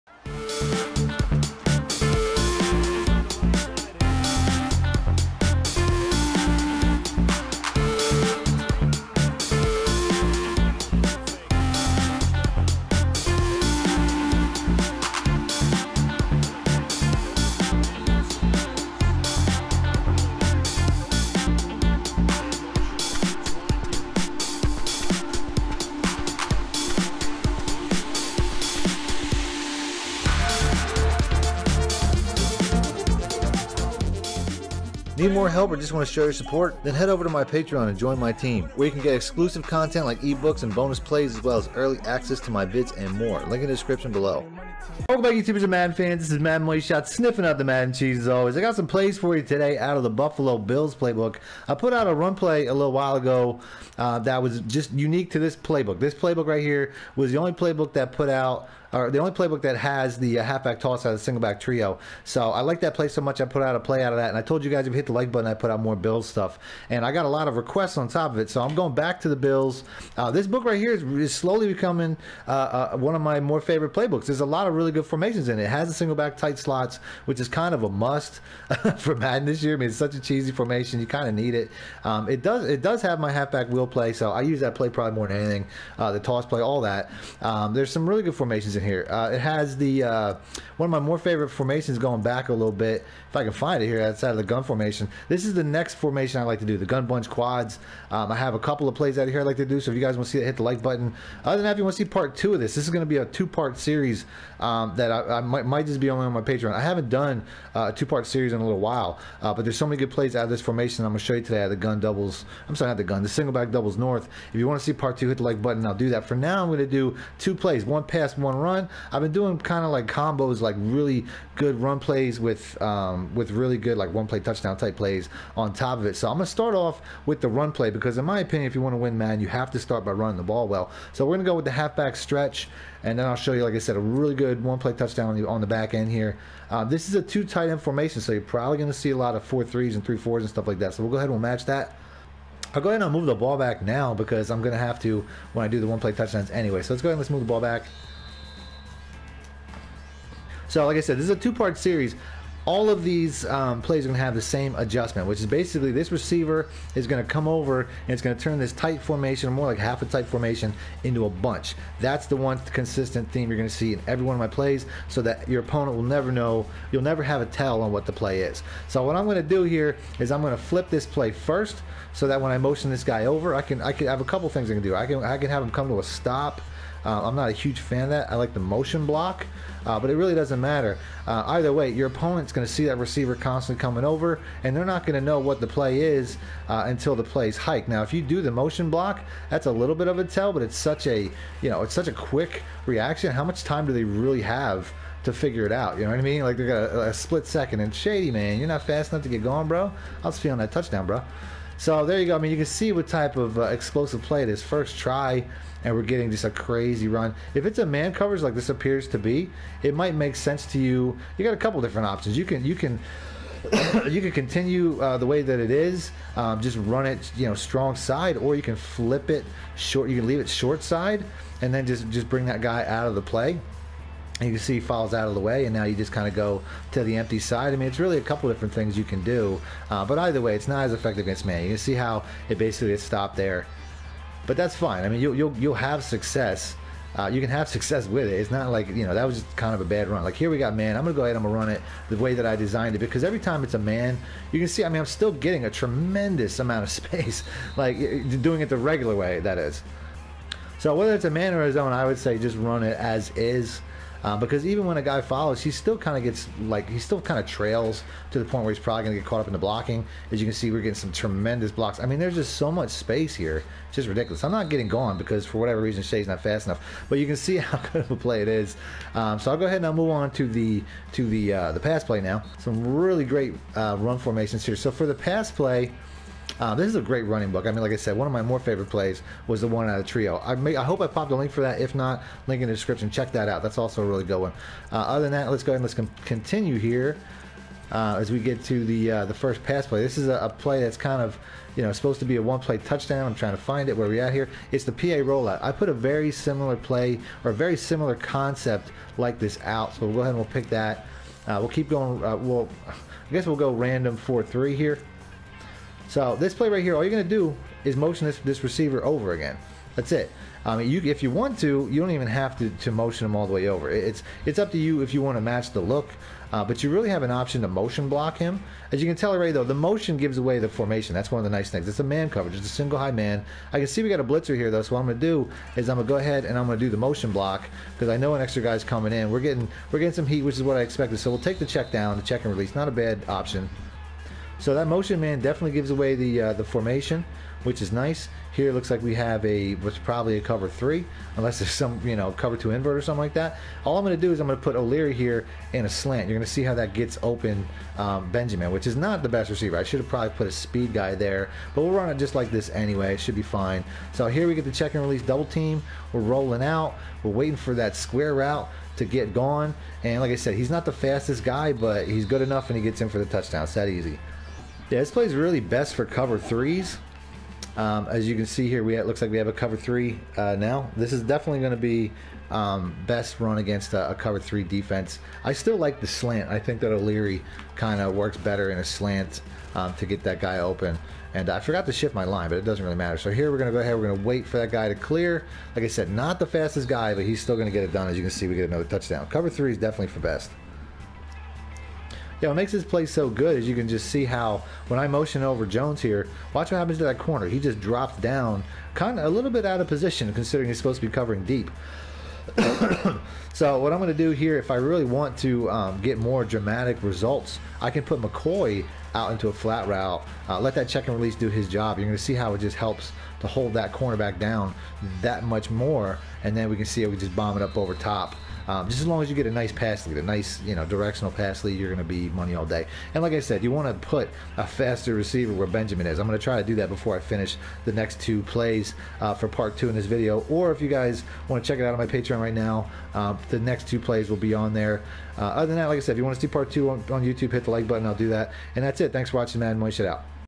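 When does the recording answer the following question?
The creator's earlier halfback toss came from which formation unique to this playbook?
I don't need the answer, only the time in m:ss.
1:01.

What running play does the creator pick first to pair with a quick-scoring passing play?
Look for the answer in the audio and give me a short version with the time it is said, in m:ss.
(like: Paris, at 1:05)
halfback stretch, at 2:11.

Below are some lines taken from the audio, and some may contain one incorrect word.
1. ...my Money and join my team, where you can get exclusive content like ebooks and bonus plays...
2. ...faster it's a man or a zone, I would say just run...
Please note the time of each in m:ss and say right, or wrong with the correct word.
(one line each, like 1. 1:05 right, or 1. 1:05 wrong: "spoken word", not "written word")
1. 0:37 wrong: "Patreon", not "Money"
2. 4:10 wrong: "whether", not "faster".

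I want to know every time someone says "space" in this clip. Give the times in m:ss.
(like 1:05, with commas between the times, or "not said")
4:06, 4:22.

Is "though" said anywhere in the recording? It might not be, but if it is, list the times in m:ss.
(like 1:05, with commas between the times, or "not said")
5:19, 5:24.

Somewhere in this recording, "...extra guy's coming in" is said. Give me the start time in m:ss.
5:28.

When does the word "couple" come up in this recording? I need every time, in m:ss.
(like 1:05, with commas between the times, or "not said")
1:38, 2:54, 3:31, 3:48.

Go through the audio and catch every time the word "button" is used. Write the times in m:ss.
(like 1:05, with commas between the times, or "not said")
1:05, 1:40, 1:55, 7:17.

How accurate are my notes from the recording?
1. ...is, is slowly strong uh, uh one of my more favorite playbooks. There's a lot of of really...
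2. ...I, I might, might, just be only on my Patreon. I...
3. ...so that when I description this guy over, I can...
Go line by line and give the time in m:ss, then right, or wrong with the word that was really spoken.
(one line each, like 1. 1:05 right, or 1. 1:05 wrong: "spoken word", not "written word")
1. 1:10 wrong: "becoming", not "strong"
2. 1:45 right
3. 2:52 wrong: "motion", not "description".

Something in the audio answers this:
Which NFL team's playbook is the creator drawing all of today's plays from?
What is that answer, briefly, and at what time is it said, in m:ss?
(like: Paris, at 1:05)
Buffalo Bills, at 0:50.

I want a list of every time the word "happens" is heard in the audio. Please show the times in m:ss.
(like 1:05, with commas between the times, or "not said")
6:36.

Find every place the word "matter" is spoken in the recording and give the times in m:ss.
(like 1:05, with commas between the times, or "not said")
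3:00, 6:22.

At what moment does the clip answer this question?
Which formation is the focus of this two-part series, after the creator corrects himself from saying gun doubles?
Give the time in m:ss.
1:53.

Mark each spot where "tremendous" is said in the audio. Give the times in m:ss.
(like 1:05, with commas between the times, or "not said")
4:05, 4:21.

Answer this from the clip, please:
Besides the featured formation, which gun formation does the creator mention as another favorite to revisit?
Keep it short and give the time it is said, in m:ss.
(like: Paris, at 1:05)
gun bunch quads, at 1:36.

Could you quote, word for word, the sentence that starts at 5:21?
That's one of the nice things.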